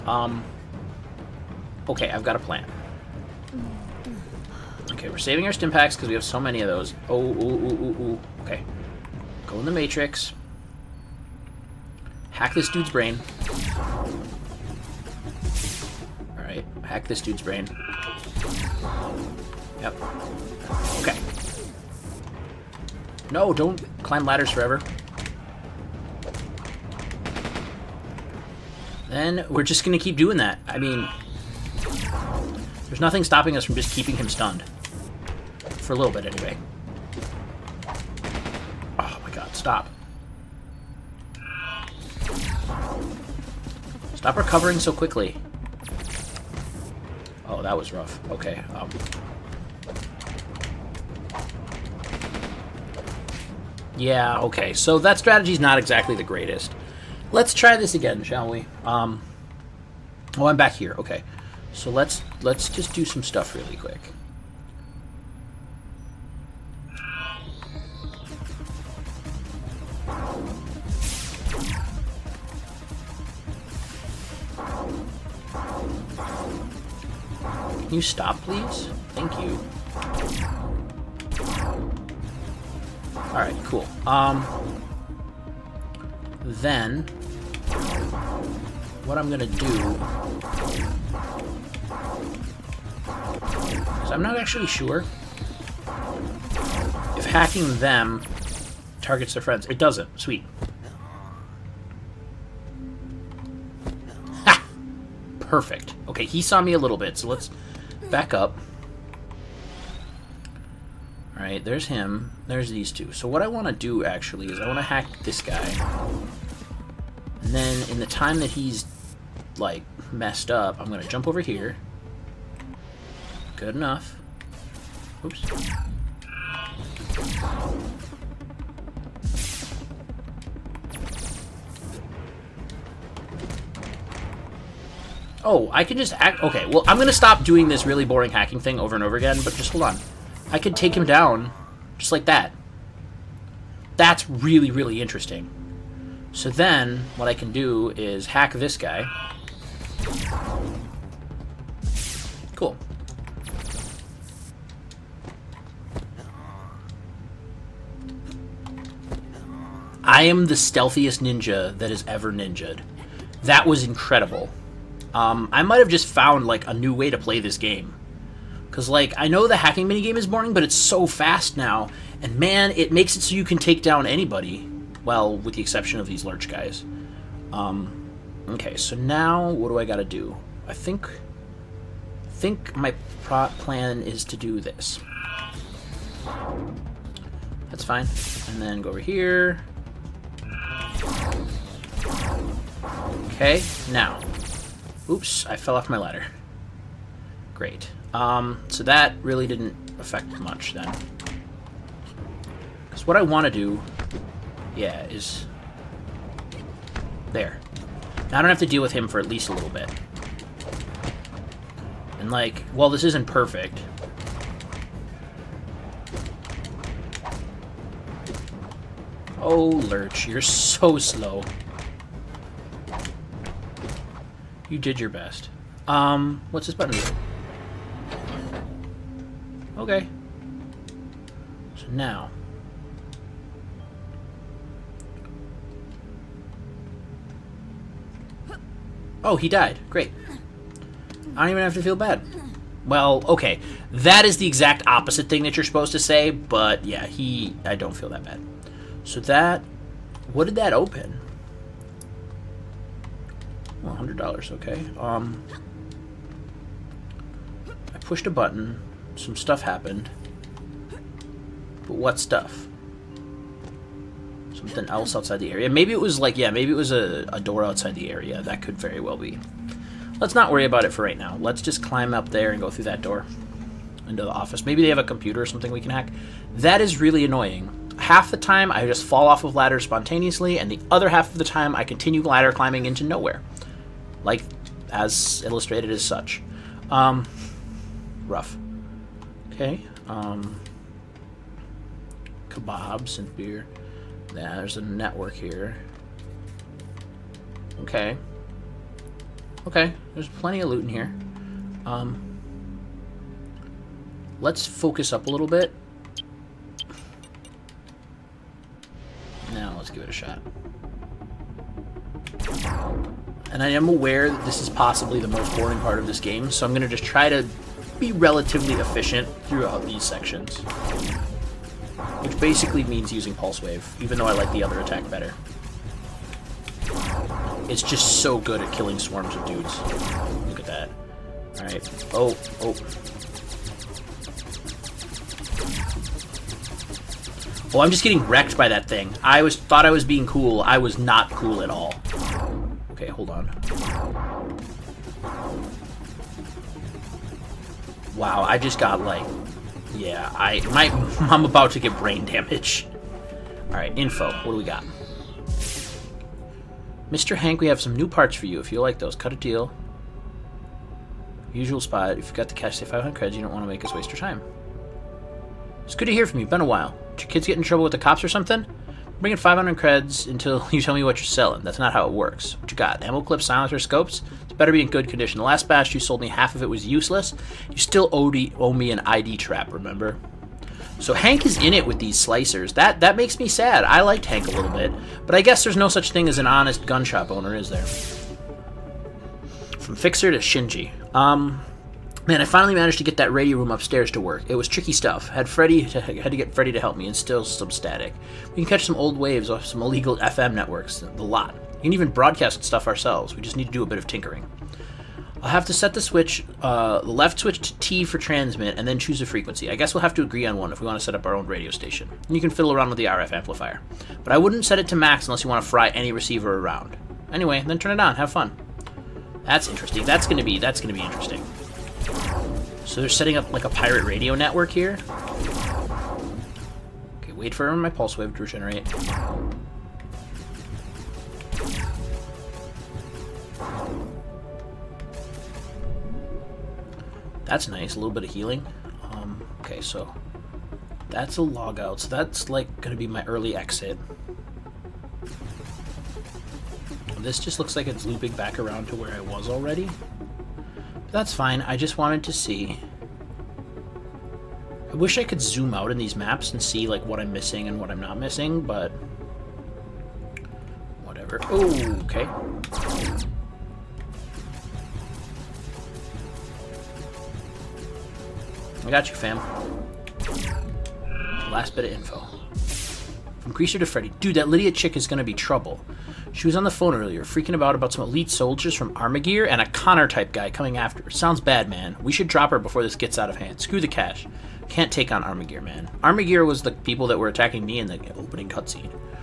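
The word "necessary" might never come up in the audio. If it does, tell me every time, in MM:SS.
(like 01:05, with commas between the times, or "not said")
not said.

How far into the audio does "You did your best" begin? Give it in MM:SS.
03:44.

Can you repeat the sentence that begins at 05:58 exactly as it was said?
If you like those, cut a deal.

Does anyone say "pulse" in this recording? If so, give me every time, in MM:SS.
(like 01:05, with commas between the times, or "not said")
05:23, 07:07.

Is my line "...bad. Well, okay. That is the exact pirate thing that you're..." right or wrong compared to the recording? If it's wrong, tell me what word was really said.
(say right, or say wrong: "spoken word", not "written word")
wrong: "opposite", not "pirate".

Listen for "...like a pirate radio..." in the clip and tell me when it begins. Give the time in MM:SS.
07:03.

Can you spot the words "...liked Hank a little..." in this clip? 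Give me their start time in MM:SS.
06:24.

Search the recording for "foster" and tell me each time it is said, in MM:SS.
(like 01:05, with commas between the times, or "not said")
not said.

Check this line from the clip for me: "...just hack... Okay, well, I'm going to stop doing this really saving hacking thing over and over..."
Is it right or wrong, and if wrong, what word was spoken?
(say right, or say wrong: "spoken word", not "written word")
wrong: "boring", not "saving".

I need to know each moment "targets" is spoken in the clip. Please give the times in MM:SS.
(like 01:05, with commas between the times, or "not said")
01:38.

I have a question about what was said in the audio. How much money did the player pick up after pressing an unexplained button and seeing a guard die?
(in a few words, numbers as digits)
$100.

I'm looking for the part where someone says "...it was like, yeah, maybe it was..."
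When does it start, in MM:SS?
04:25.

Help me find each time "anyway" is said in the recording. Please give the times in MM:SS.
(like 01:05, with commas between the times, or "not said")
00:36, 06:57.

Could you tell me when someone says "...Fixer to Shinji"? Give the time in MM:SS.
06:29.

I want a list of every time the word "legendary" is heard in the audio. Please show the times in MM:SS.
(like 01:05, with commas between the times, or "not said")
not said.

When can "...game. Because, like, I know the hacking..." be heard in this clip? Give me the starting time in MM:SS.
02:47.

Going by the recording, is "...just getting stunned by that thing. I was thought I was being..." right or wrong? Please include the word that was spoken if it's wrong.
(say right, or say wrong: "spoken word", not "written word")
wrong: "wrecked", not "stunned".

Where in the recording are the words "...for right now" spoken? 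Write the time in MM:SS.
04:30.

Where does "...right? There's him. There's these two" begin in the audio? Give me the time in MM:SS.
01:51.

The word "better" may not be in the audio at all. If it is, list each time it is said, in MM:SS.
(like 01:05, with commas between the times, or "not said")
05:25, 06:14.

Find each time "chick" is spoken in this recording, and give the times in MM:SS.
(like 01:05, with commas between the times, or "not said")
07:54.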